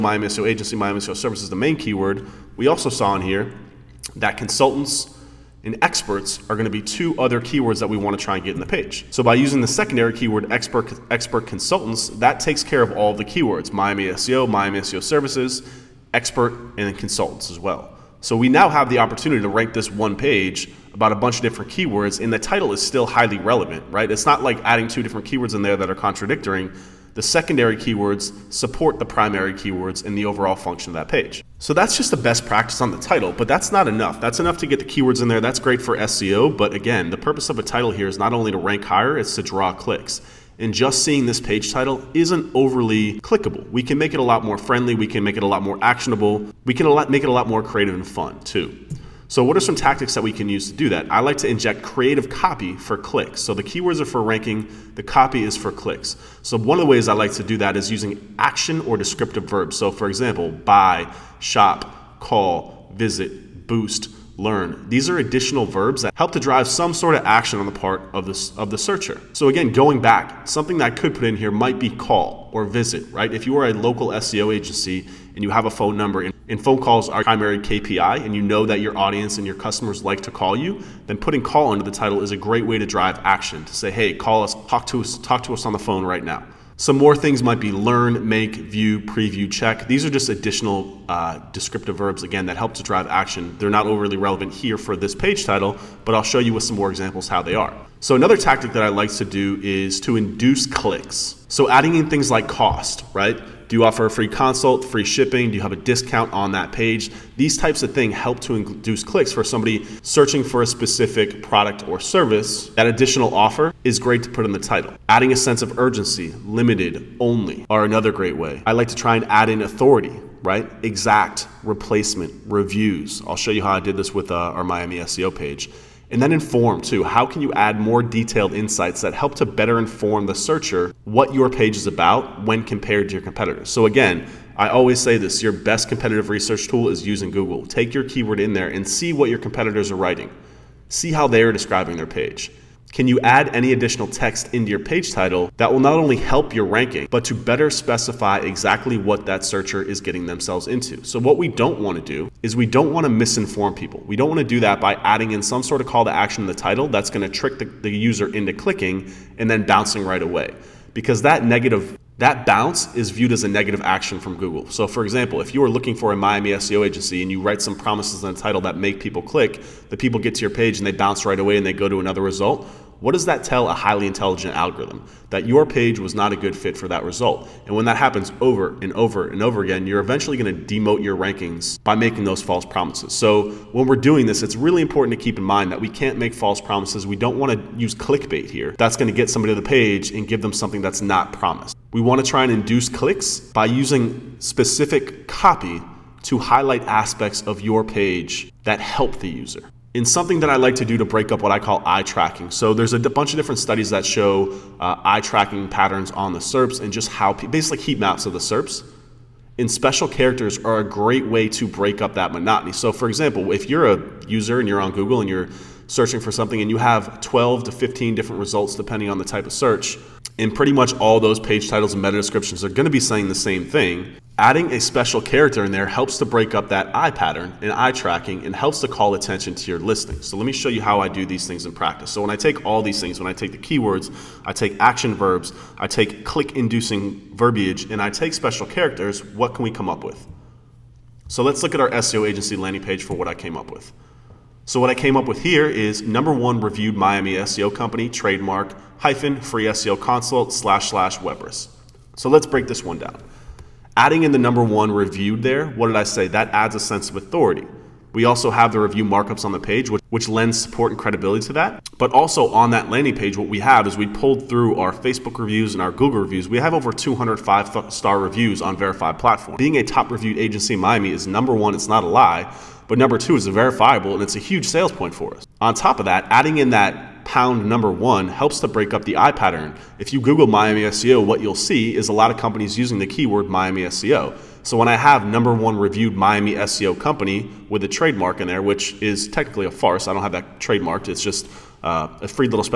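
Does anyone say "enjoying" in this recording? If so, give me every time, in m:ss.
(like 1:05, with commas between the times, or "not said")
not said.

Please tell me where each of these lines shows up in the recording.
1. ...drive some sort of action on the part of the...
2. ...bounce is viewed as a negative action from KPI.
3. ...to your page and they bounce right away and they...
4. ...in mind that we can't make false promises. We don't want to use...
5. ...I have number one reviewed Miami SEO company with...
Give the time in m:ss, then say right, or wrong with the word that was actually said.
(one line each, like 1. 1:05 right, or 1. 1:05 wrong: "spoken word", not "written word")
1. 1:06 right
2. 2:42 wrong: "Google", not "KPI"
3. 2:50 right
4. 3:05 right
5. 4:44 right.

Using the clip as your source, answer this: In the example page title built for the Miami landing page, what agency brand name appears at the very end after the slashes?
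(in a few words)
Webris.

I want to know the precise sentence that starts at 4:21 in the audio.
But also on that landing page, what we have is we pulled through our Facebook reviews and our Google reviews.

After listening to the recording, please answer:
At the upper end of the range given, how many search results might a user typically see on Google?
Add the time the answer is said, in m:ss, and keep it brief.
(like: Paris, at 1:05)
15, at 3:37.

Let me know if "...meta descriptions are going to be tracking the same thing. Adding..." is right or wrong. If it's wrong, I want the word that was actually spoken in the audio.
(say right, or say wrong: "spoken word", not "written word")
wrong: "saying", not "tracking".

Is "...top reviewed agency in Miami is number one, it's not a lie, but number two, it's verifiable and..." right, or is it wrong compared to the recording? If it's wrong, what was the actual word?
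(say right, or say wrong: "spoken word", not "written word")
right.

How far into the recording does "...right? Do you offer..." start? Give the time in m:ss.
1:43.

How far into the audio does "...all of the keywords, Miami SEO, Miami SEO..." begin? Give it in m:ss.
0:12.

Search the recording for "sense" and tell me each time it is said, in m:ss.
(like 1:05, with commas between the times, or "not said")
1:55, 4:16.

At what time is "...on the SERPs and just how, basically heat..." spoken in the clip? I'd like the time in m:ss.
3:26.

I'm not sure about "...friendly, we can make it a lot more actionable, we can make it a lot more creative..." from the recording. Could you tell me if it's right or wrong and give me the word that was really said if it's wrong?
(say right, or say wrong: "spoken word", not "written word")
right.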